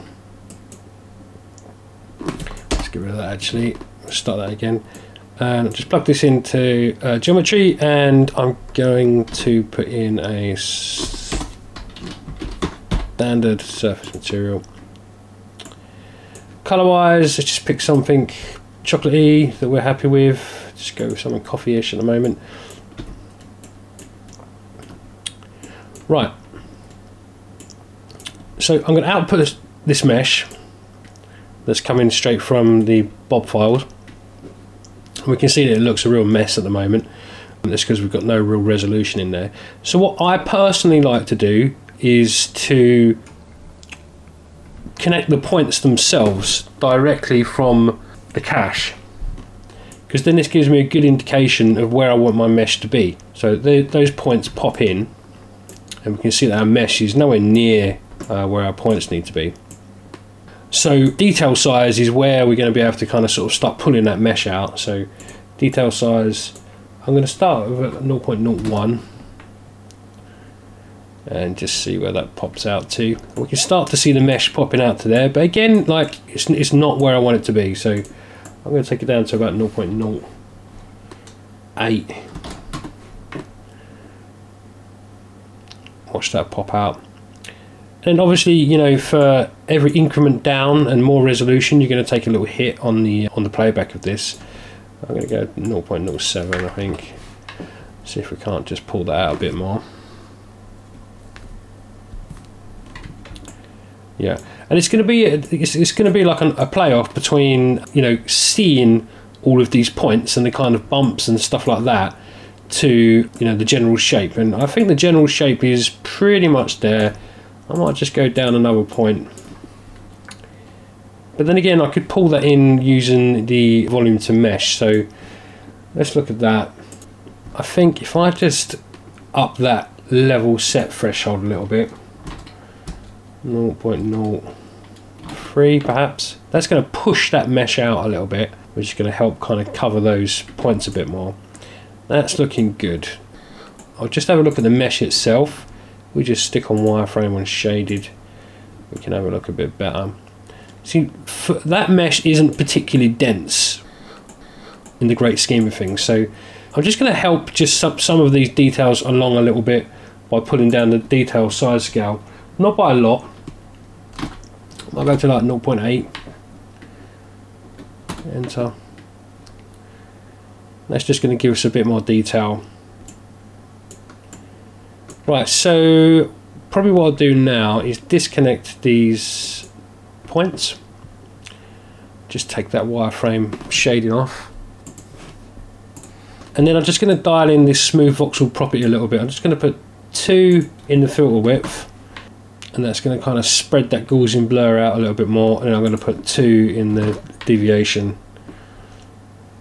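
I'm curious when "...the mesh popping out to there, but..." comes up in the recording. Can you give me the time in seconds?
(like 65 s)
74 s.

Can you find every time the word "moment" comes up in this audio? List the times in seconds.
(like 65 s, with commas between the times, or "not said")
22 s, 36 s.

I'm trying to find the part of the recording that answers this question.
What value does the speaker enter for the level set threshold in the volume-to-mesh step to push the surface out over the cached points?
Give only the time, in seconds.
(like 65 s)
133 s.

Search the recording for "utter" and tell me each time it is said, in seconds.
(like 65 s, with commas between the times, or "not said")
not said.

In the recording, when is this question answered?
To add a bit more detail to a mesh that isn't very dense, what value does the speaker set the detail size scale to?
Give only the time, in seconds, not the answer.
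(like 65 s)
165 s.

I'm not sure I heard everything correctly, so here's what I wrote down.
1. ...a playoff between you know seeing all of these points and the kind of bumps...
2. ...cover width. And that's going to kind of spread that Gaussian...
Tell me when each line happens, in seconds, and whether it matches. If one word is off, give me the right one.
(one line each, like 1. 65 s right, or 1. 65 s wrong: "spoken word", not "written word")
1. 106 s right
2. 191 s wrong: "filter", not "cover".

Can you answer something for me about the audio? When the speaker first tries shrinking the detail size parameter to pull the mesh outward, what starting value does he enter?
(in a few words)
0.01.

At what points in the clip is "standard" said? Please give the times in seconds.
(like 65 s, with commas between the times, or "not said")
10 s.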